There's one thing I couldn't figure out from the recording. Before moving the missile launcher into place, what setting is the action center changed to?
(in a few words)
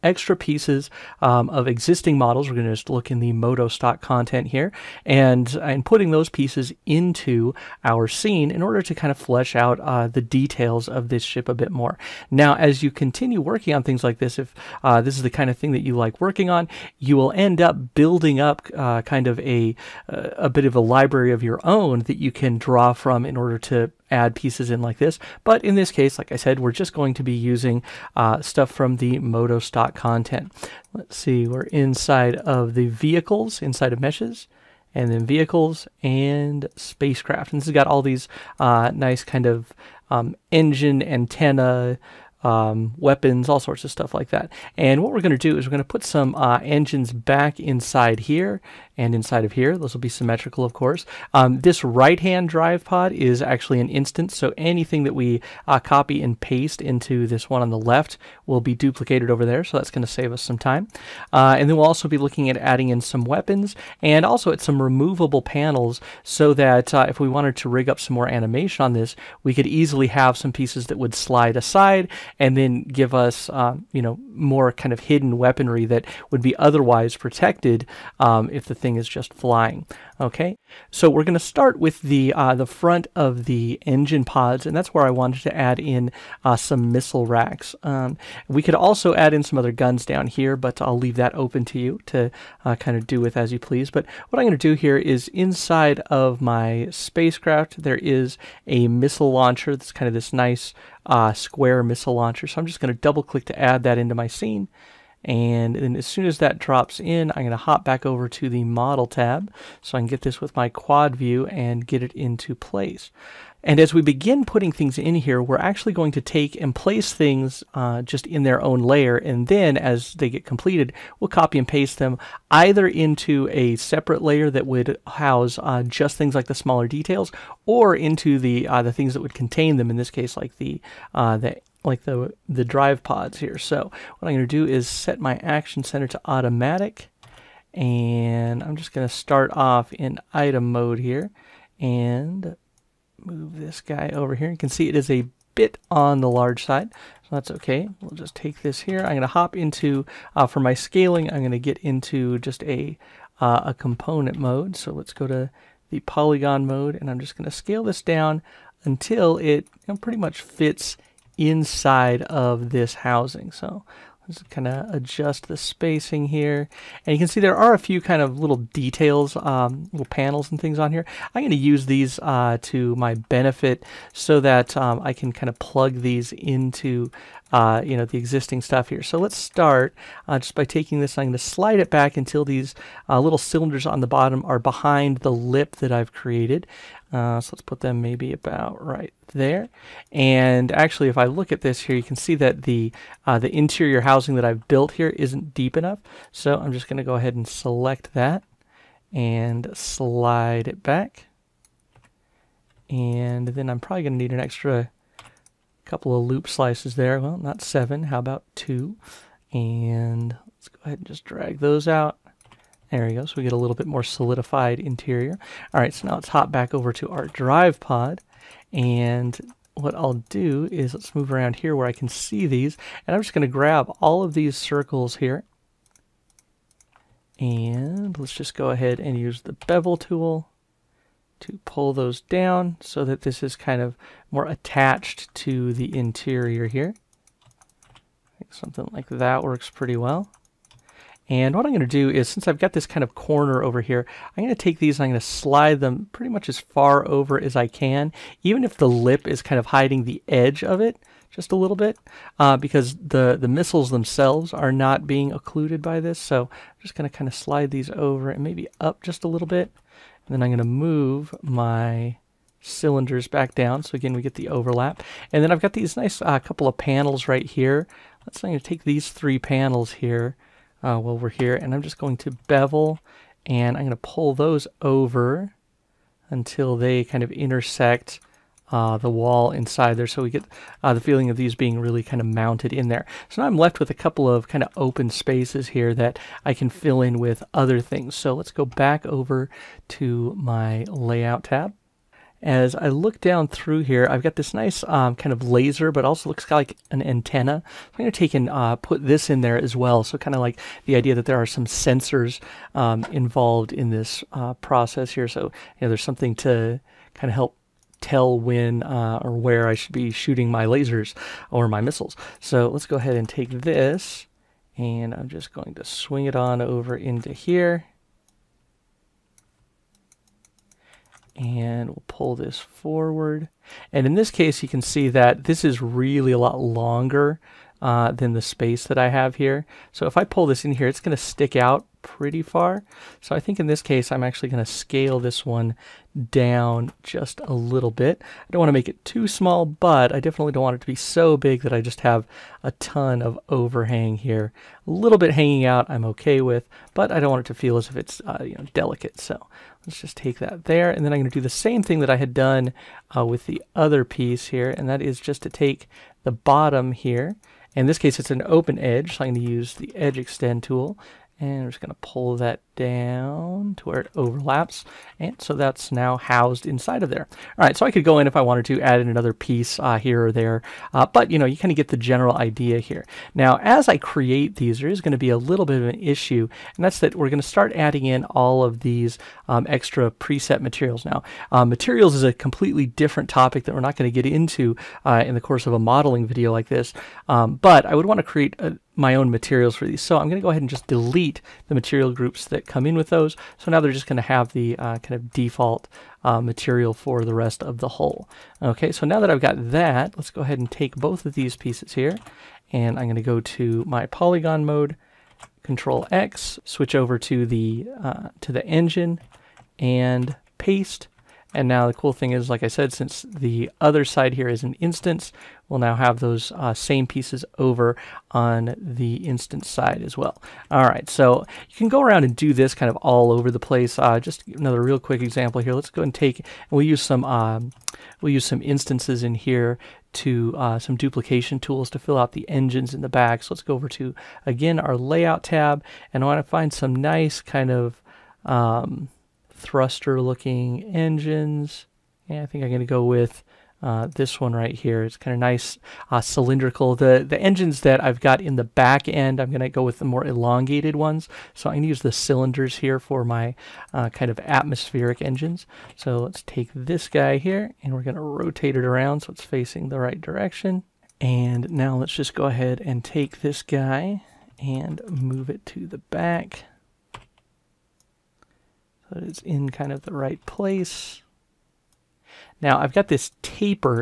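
Automatic.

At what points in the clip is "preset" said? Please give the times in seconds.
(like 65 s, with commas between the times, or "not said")
380 s.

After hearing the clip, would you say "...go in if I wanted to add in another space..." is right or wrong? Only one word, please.
wrong.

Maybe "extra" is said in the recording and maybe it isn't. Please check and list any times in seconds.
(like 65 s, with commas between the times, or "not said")
0 s, 204 s, 379 s.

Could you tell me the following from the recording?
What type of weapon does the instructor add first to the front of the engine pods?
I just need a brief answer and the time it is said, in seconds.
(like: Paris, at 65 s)
Missile racks, at 86 s.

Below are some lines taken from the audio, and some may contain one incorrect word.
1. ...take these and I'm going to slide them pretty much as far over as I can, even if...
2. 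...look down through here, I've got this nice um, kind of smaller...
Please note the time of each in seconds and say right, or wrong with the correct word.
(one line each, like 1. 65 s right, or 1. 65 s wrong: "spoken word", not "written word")
1. 244 s right
2. 292 s wrong: "laser", not "smaller".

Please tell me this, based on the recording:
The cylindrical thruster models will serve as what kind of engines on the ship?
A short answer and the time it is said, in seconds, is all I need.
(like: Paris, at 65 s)
Atmospheric engines, at 454 s.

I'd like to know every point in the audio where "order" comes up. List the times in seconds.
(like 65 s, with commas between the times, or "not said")
8 s, 23 s.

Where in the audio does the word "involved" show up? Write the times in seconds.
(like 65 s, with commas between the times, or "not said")
303 s.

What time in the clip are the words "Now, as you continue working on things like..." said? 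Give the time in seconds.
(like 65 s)
12 s.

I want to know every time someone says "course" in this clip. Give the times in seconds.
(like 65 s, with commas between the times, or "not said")
50 s, 385 s.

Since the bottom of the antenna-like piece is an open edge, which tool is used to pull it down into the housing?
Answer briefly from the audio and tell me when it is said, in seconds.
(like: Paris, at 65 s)
Edge extend tool, at 359 s.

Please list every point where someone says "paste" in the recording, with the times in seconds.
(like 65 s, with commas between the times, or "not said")
56 s, 121 s, 410 s.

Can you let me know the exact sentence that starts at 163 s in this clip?
So let's kind of adjust the spacing here.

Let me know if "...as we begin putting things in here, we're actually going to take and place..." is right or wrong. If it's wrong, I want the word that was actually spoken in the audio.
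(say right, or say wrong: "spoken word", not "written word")
right.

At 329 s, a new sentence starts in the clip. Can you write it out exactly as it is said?
So if I pull this in here, it's going to stick out pretty far.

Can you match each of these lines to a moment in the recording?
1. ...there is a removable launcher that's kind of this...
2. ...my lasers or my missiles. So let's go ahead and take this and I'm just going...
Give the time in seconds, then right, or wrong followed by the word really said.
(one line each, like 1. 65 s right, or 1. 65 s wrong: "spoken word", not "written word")
1. 97 s wrong: "missile", not "removable"
2. 310 s right.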